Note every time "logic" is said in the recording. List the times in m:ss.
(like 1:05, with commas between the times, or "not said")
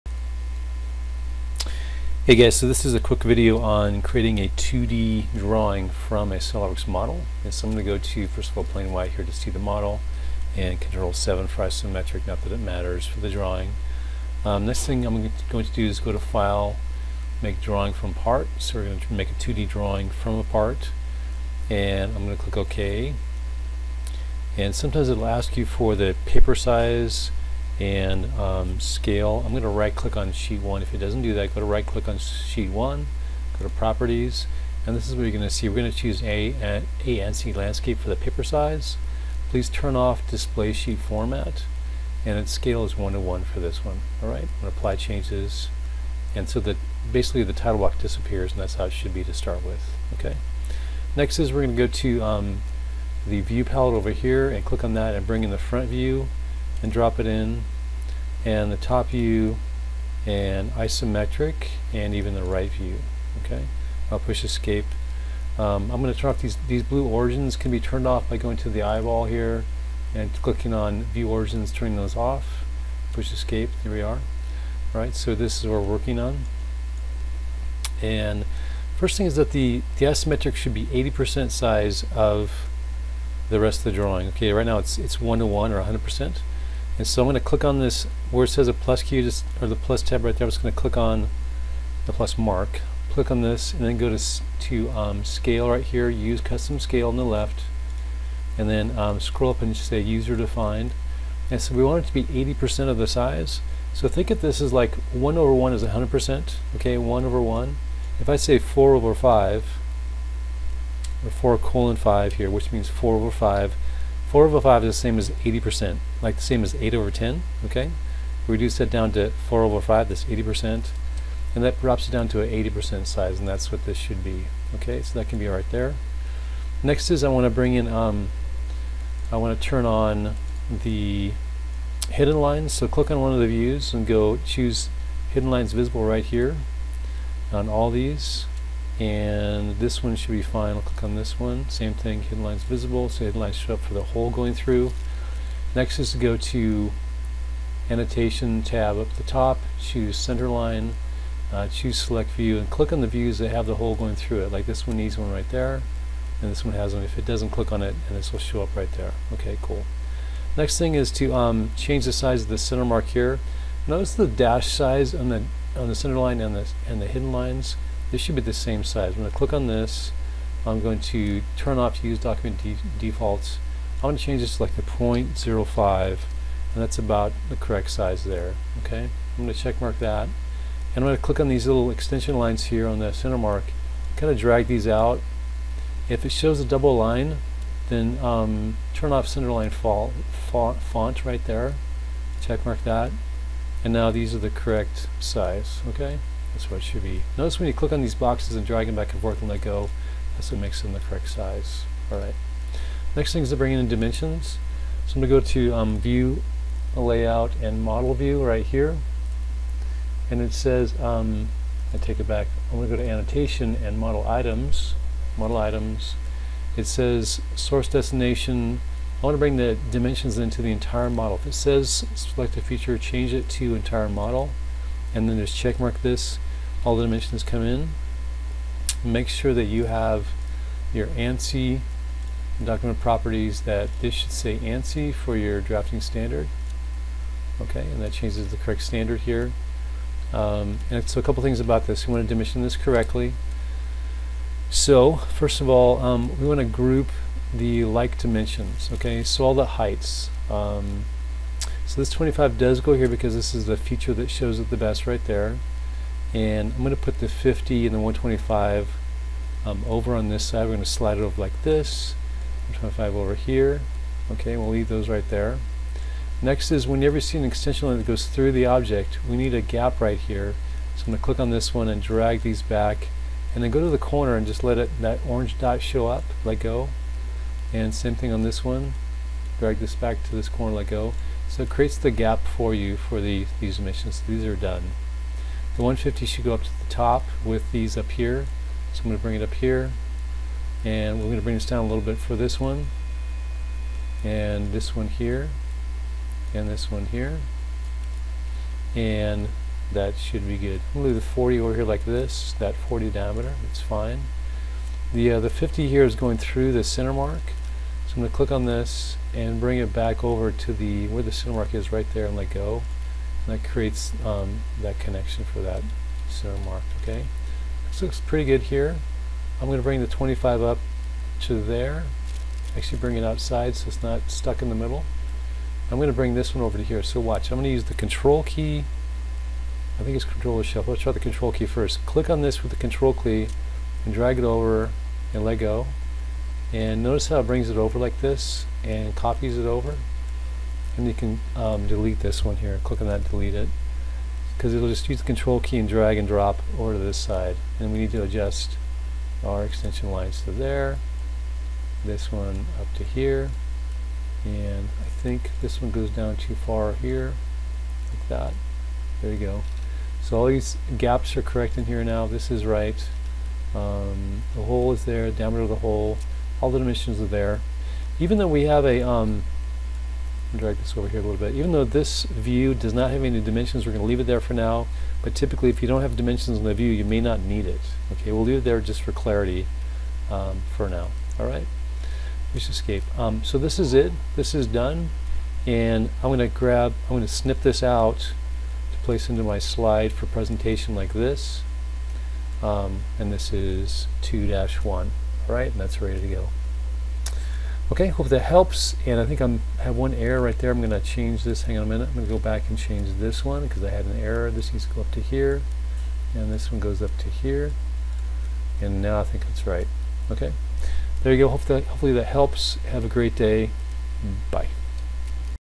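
not said.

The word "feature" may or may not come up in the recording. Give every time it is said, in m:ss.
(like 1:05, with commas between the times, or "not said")
3:42, 4:13.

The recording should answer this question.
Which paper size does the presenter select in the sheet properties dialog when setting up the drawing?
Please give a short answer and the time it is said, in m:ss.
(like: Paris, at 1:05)
A landscape, at 0:37.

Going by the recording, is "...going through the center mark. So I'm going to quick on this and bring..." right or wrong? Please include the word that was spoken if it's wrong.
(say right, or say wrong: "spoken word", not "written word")
wrong: "click", not "quick".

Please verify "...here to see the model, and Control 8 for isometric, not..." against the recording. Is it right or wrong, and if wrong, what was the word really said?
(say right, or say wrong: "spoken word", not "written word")
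wrong: "7", not "8".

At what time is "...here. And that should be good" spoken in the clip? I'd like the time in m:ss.
4:57.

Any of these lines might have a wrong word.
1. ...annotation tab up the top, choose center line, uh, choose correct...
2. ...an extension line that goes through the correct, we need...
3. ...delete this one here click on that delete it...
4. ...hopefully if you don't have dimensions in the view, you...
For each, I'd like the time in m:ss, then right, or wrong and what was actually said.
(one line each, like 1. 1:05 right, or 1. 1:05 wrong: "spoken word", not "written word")
1. 2:27 wrong: "select", not "correct"
2. 4:27 wrong: "object", not "correct"
3. 5:41 right
4. 6:15 wrong: "typically", not "hopefully".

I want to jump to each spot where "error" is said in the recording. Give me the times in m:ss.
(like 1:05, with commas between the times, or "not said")
6:40, 6:44.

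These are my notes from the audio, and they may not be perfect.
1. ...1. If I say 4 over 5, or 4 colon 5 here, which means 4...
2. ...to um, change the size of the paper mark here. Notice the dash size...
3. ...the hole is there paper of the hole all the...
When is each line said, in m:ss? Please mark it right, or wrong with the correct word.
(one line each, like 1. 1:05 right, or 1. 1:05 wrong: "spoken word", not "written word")
1. 1:47 right
2. 2:41 wrong: "center", not "paper"
3. 6:04 wrong: "diameter", not "paper".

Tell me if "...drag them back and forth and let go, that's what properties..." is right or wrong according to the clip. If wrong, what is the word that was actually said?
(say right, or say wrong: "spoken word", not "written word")
wrong: "makes", not "properties".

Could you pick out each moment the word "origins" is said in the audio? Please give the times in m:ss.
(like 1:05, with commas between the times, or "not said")
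1:07, 1:11.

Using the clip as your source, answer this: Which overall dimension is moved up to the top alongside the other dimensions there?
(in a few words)
150.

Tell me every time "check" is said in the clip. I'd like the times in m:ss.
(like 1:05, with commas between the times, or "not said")
2:59, 3:12, 3:45.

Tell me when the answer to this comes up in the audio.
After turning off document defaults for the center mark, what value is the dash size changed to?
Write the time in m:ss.
2:54.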